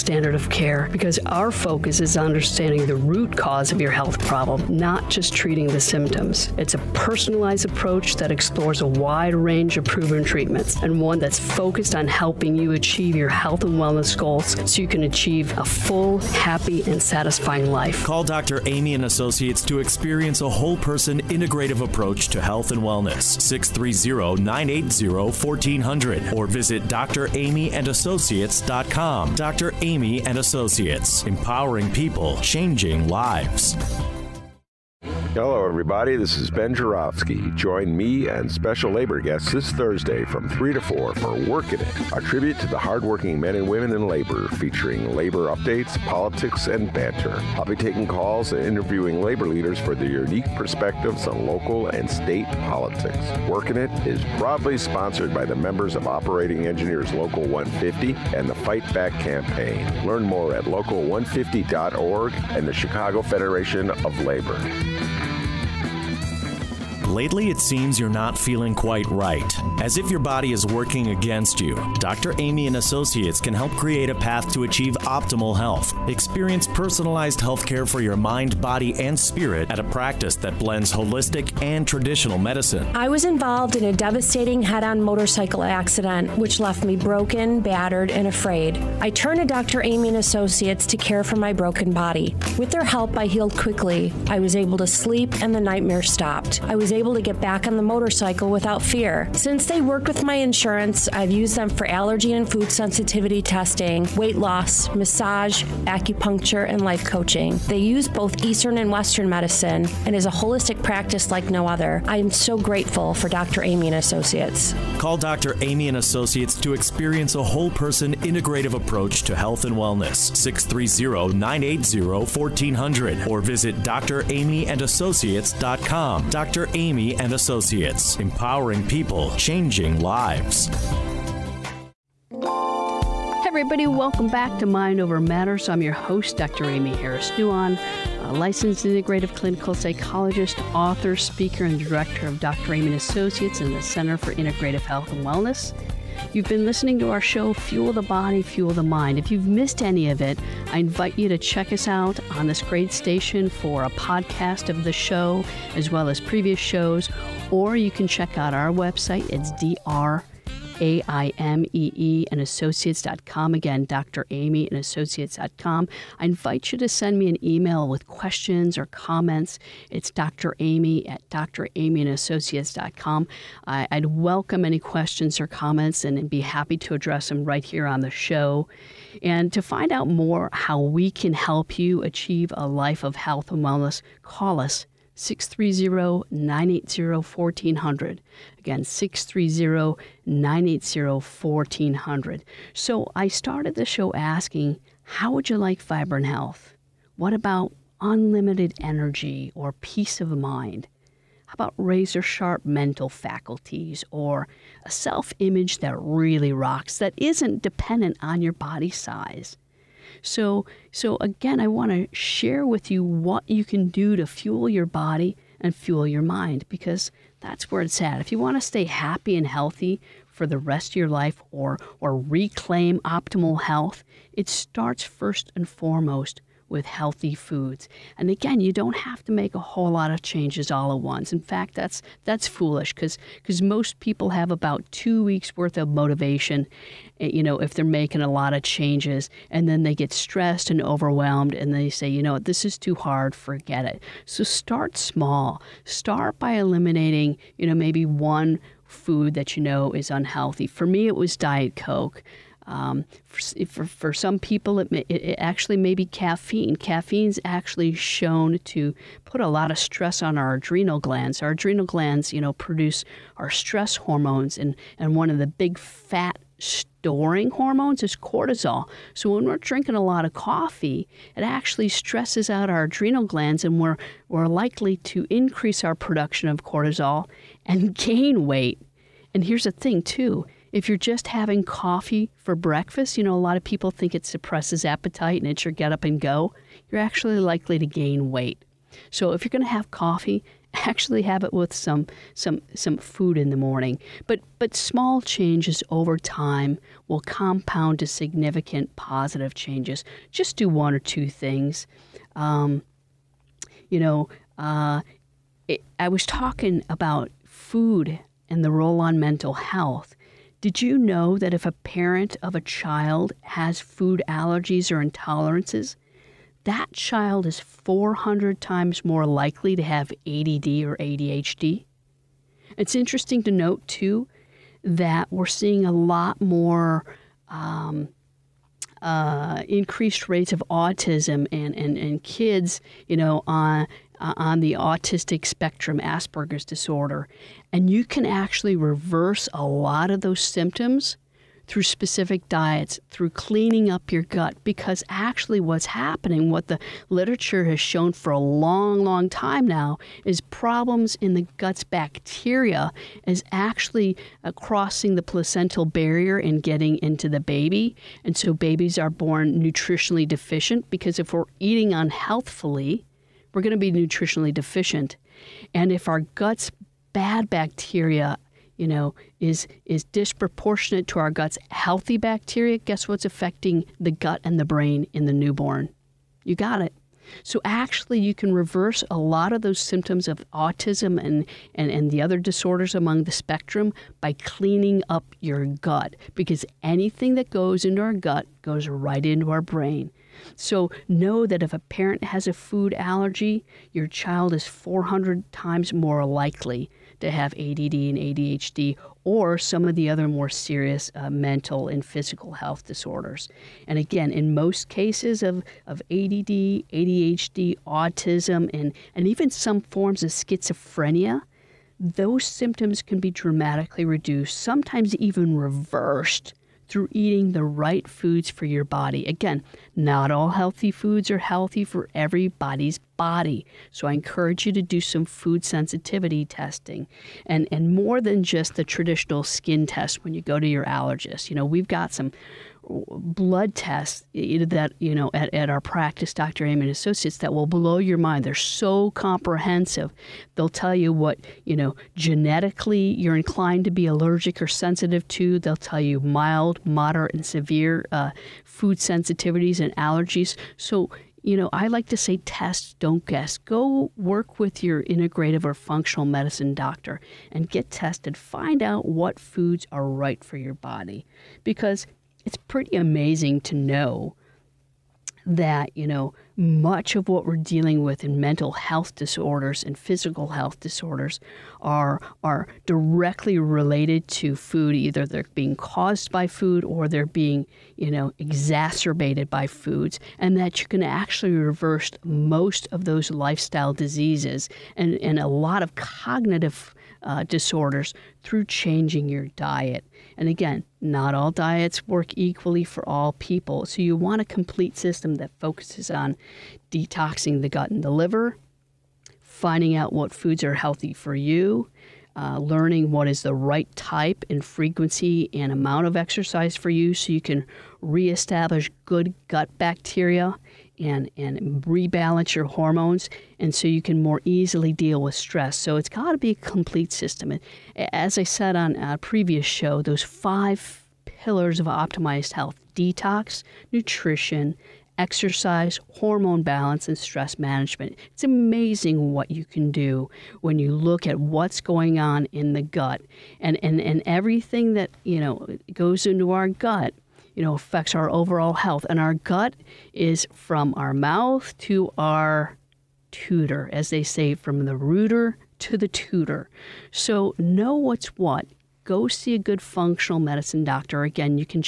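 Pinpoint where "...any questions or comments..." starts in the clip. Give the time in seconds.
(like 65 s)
174 s.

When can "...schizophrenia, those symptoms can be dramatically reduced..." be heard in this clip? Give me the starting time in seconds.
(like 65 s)
410 s.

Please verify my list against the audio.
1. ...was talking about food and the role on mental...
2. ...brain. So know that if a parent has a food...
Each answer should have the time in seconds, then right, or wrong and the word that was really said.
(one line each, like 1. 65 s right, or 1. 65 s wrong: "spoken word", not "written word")
1. 306 s right
2. 389 s right.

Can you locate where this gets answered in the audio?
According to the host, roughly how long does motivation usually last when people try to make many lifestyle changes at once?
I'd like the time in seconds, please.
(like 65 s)
234 s.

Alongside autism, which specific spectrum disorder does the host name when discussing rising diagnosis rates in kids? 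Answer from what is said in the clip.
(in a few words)
Asperger's disorder.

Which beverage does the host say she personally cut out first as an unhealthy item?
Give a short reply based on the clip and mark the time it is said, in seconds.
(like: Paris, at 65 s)
Diet Coke, at 251 s.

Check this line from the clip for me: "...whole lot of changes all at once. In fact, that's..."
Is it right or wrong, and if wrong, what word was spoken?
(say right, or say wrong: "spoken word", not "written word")
right.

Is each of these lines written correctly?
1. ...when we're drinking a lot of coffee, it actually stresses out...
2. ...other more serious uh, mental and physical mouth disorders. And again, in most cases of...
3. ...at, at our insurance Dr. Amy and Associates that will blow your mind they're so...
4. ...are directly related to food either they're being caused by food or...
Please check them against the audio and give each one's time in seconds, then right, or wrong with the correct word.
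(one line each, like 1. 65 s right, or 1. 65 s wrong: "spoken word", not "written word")
1. 269 s right
2. 400 s wrong: "health", not "mouth"
3. 435 s wrong: "practice", not "insurance"
4. 472 s right.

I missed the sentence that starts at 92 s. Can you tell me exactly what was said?
With their help, I healed quickly.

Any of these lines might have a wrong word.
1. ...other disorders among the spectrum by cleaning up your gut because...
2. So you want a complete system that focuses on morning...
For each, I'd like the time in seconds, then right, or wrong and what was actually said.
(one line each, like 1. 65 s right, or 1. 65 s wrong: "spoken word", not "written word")
1. 382 s right
2. 493 s wrong: "detoxing", not "morning".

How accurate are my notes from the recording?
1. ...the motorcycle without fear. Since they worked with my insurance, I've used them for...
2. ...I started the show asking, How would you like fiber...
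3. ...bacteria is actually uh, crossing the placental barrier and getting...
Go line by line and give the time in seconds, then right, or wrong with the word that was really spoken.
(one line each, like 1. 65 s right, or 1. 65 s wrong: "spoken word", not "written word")
1. 97 s right
2. 193 s right
3. 351 s right.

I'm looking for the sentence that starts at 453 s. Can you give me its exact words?
Go work with your integrative or functional medicine doctor and get tested.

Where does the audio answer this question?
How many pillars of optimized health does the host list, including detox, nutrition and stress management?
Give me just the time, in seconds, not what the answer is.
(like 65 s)
520 s.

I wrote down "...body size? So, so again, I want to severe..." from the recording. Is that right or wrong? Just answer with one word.
wrong.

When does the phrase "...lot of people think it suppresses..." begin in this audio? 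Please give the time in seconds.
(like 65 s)
283 s.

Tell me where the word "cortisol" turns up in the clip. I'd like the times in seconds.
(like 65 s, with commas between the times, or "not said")
268 s, 276 s.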